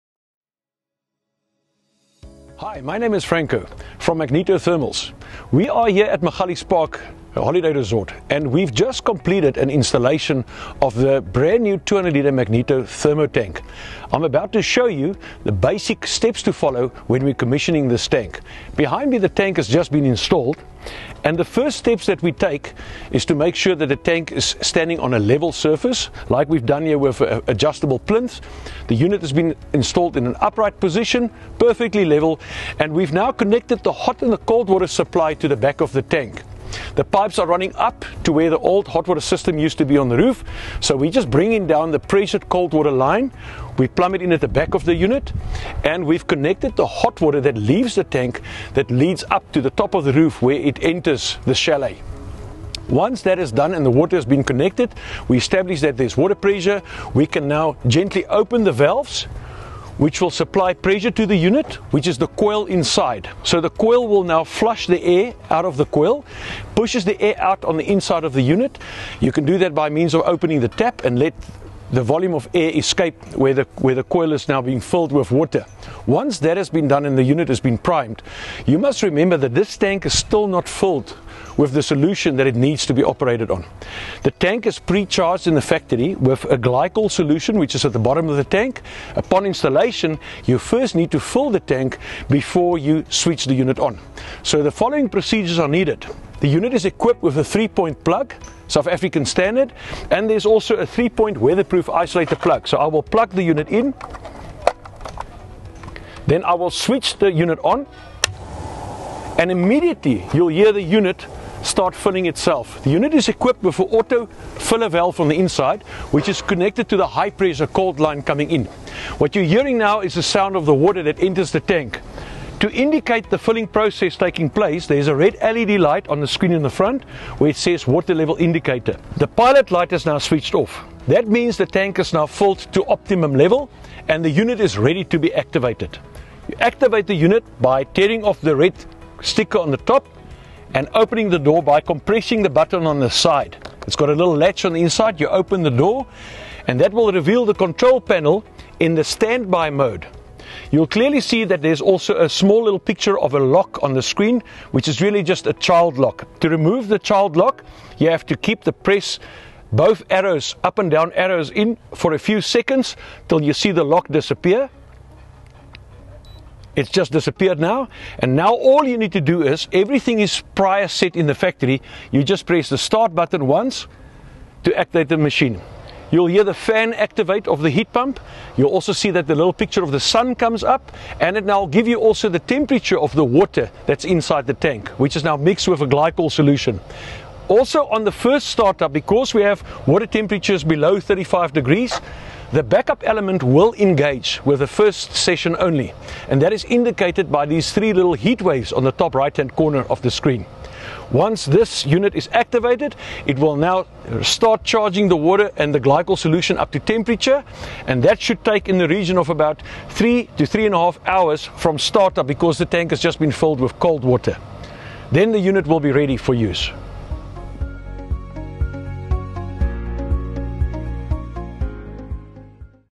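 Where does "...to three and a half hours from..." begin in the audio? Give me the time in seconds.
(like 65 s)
210 s.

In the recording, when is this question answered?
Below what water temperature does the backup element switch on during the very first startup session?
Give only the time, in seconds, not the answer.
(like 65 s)
190 s.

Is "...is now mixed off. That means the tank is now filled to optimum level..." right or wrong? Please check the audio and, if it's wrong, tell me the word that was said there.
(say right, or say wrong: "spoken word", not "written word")
wrong: "switched", not "mixed".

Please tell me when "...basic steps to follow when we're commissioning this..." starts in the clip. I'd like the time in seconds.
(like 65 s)
15 s.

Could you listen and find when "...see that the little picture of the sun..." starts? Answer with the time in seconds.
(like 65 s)
178 s.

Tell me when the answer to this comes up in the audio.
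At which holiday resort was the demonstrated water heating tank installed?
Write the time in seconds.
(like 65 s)
6 s.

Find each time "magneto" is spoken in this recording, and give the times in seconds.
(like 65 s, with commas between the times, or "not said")
4 s, 12 s.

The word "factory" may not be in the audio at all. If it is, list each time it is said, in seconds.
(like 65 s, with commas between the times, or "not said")
85 s, 171 s.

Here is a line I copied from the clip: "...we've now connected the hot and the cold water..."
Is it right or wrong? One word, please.
right.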